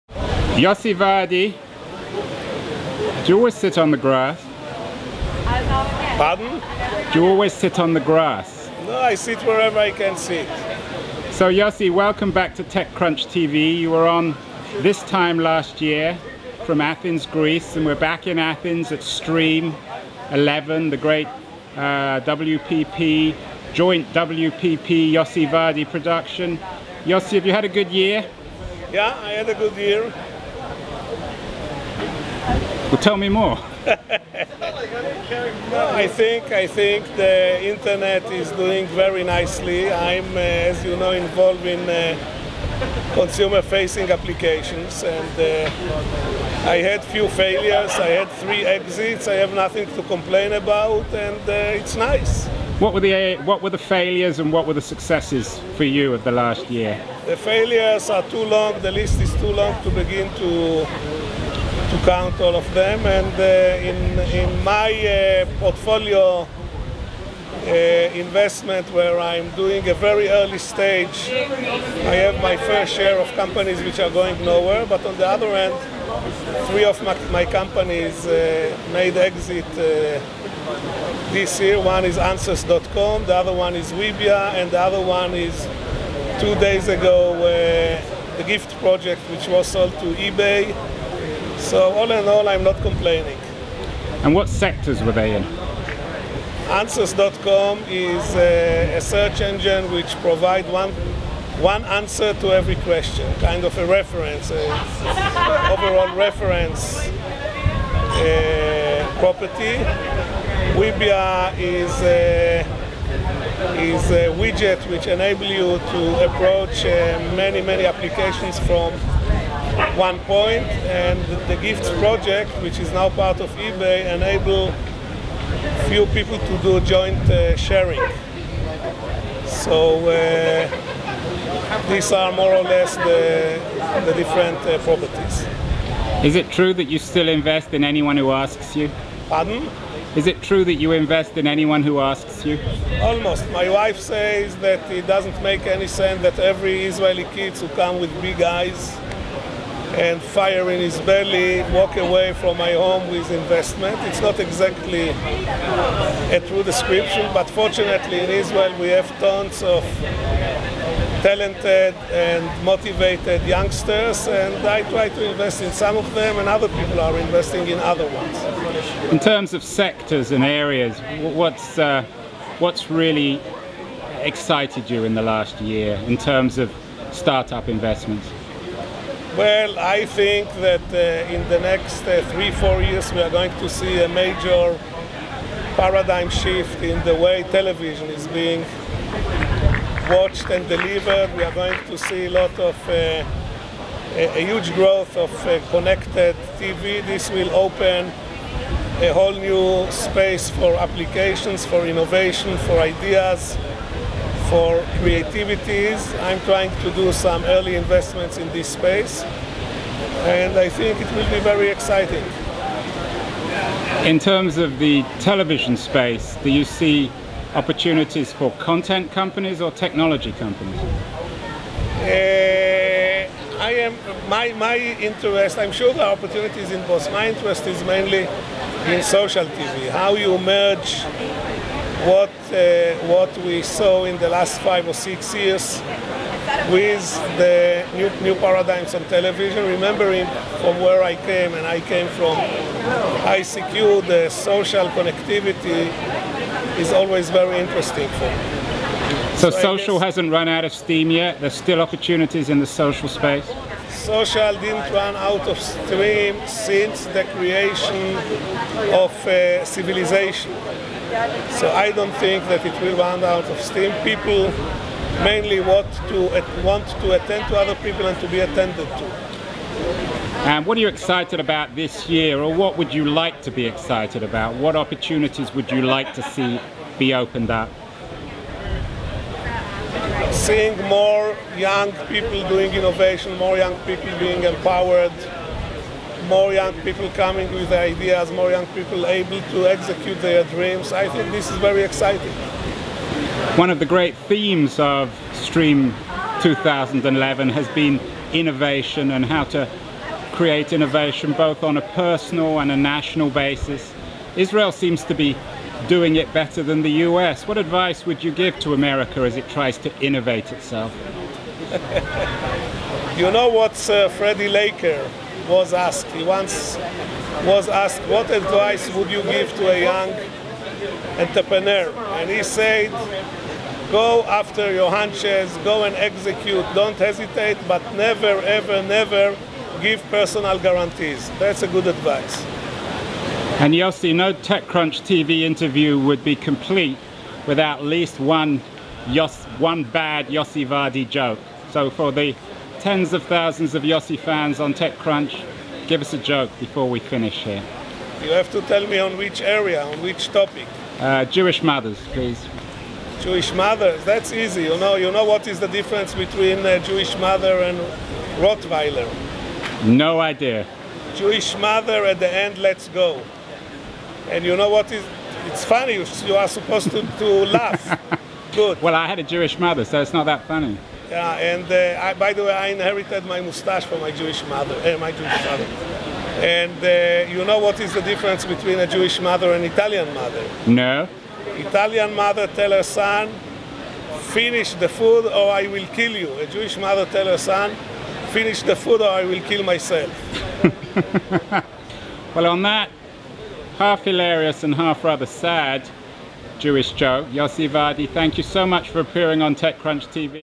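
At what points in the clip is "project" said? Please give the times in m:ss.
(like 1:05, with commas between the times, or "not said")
1:28, 2:01.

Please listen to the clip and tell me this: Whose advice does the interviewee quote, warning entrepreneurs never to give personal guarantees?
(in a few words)
Freddie Laker.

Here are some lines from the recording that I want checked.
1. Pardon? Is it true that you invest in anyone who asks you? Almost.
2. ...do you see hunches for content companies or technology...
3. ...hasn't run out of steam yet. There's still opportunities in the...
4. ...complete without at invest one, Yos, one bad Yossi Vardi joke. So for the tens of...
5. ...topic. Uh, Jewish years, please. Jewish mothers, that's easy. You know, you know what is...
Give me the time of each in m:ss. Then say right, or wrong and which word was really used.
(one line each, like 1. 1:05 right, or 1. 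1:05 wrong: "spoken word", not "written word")
1. 2:19 right
2. 3:36 wrong: "opportunities", not "hunches"
3. 4:10 right
4. 5:36 wrong: "least", not "invest"
5. 5:50 wrong: "mothers", not "years".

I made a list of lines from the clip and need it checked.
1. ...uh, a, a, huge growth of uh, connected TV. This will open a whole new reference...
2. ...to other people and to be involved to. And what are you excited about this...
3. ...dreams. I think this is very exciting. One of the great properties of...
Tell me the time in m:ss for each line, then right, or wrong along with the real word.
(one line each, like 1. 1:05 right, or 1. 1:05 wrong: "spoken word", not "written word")
1. 3:12 wrong: "space", not "reference"
2. 4:27 wrong: "attended", not "involved"
3. 4:50 wrong: "themes", not "properties".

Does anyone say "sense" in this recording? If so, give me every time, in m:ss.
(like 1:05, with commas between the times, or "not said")
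2:25.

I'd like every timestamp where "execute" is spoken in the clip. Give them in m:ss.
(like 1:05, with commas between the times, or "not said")
4:49, 5:25.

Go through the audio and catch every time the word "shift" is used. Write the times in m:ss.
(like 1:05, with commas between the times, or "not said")
3:06.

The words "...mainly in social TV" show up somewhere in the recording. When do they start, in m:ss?
3:47.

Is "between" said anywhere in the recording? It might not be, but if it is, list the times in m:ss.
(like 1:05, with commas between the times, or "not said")
5:56, 6:18.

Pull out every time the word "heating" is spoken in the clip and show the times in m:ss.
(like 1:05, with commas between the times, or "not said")
not said.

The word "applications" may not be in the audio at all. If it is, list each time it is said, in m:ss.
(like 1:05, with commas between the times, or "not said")
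0:44, 1:57, 3:20.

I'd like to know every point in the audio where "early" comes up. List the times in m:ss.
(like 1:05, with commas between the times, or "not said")
1:10, 3:27.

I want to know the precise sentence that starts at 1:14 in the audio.
But on the other hand, three of my, my companies made exit this year.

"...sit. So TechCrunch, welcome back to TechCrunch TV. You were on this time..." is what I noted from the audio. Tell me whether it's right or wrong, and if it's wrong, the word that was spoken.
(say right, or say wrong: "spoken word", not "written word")
wrong: "Yossi", not "TechCrunch".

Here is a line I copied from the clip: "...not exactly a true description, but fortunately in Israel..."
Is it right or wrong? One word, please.
right.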